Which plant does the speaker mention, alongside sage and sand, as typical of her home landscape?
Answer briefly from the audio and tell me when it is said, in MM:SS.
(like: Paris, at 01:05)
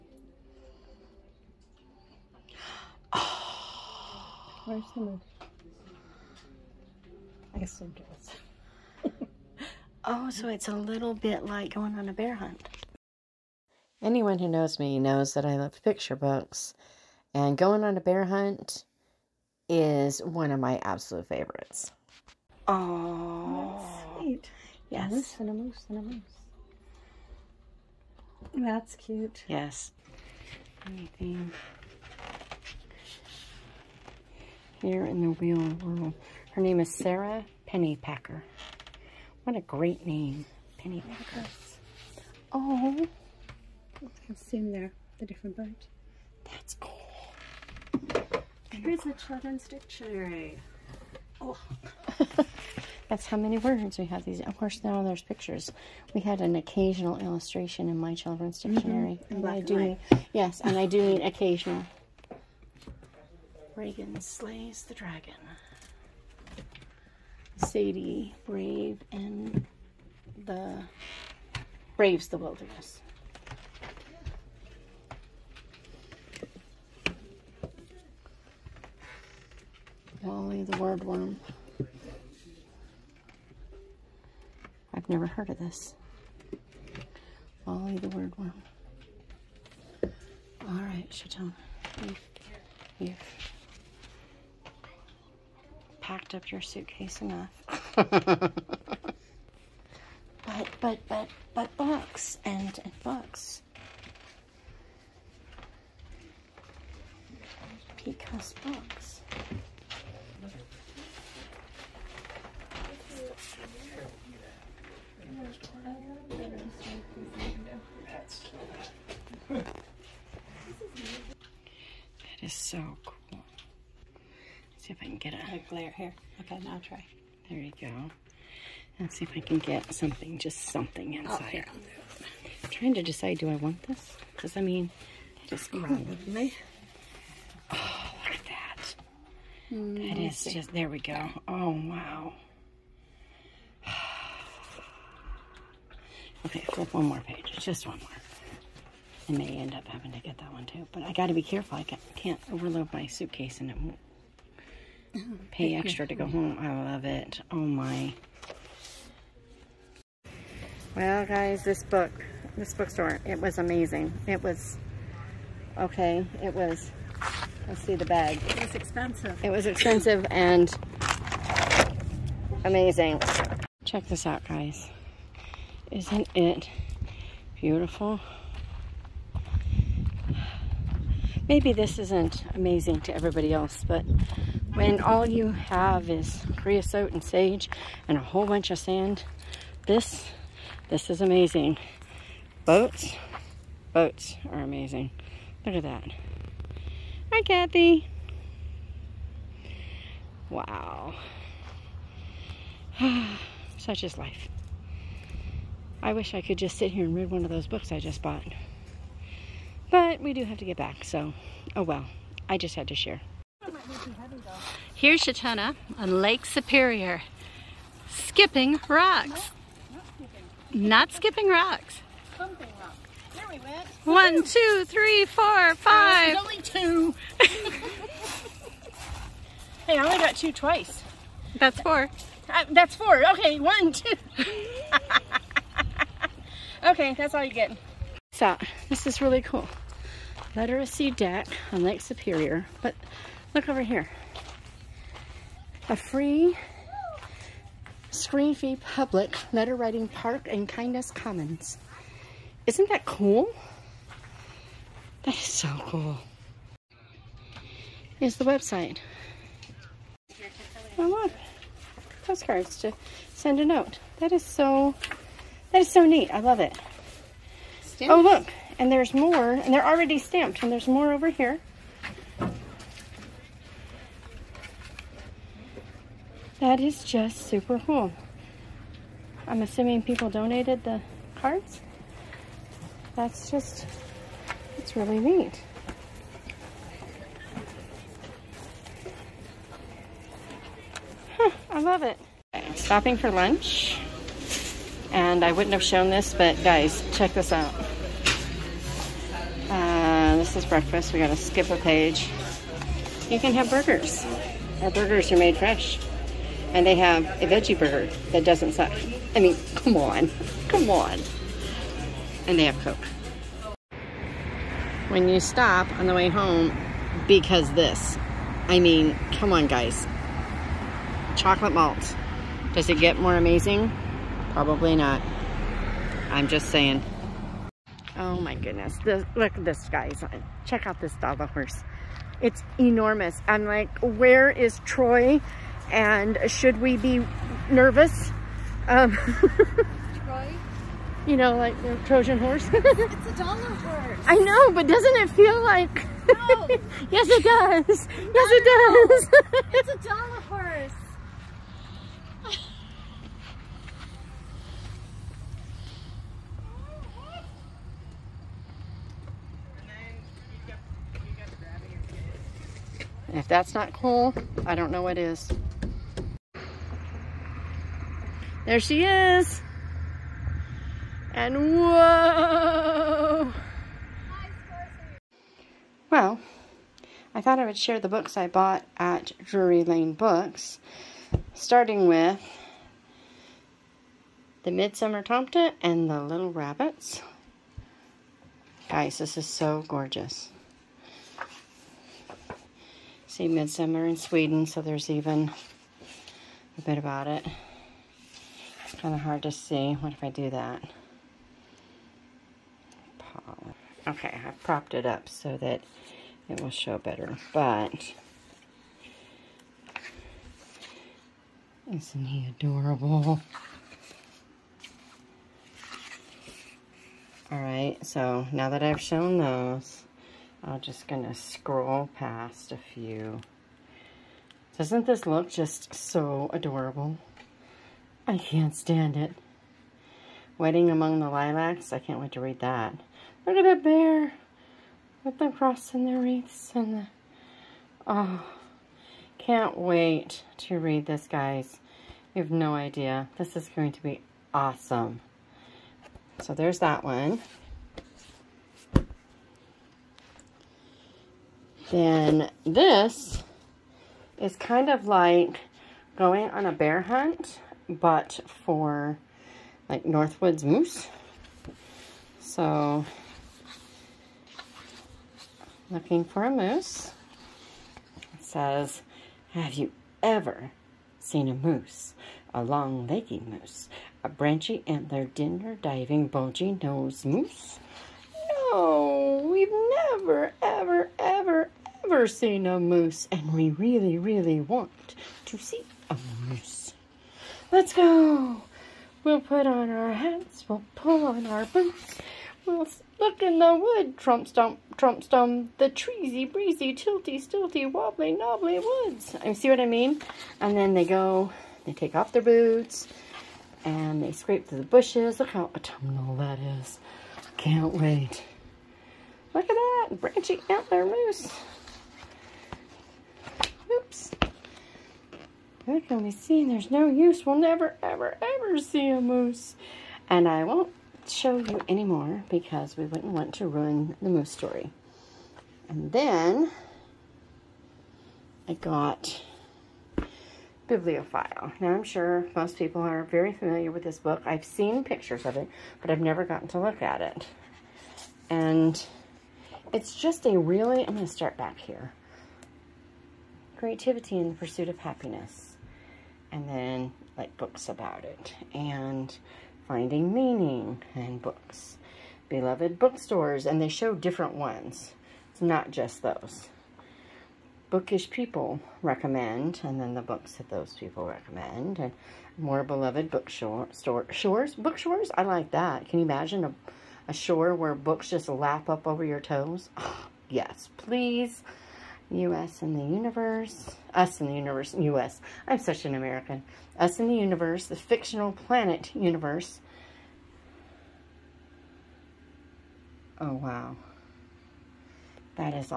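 Creosote, at 03:06.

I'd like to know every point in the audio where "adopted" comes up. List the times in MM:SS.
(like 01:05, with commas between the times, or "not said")
not said.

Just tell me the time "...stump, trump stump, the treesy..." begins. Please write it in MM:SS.
08:14.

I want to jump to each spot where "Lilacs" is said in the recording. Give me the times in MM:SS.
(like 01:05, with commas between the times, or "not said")
07:11.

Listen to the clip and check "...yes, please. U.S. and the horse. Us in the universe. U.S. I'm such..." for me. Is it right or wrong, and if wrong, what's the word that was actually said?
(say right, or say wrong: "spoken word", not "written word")
wrong: "universe", not "horse".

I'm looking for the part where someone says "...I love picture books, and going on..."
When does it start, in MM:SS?
00:15.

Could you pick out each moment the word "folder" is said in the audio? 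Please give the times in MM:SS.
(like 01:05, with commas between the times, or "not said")
not said.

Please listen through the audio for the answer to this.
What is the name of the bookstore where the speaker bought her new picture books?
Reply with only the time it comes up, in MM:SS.
06:19.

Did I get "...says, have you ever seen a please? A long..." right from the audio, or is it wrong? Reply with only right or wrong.
wrong.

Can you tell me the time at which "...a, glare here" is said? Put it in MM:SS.
02:05.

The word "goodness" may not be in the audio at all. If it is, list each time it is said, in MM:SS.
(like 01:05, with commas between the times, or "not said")
05:28.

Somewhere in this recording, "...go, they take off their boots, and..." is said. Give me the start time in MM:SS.
08:21.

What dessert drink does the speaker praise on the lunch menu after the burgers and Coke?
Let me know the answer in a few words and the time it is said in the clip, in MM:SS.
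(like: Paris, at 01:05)
Chocolate malt, at 05:21.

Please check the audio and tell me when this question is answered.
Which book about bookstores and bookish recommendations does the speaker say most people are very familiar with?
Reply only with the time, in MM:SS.
08:50.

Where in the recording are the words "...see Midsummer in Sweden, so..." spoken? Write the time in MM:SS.
06:33.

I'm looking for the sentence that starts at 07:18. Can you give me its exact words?
Oh, can't wait to read this, guys.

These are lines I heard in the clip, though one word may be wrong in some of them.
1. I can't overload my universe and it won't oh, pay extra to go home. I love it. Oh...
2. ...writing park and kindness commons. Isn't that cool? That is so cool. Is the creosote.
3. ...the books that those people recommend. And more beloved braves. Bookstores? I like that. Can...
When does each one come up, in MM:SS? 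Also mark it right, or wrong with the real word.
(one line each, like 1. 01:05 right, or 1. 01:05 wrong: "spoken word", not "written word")
1. 02:31 wrong: "suitcase", not "universe"
2. 04:09 wrong: "website", not "creosote"
3. 09:20 wrong: "bookstores", not "braves".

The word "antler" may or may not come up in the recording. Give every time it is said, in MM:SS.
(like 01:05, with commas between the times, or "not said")
07:54, 08:30.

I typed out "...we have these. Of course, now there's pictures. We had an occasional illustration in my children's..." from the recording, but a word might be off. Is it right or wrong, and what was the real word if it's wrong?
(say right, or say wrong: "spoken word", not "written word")
right.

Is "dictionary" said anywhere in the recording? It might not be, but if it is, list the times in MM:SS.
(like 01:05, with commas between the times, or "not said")
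00:49, 00:58.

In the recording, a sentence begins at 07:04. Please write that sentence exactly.
Doesn't this look just so adorable?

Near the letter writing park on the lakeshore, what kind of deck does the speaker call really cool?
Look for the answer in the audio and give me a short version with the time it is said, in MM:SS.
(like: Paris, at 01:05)
Literacy deck, at 04:00.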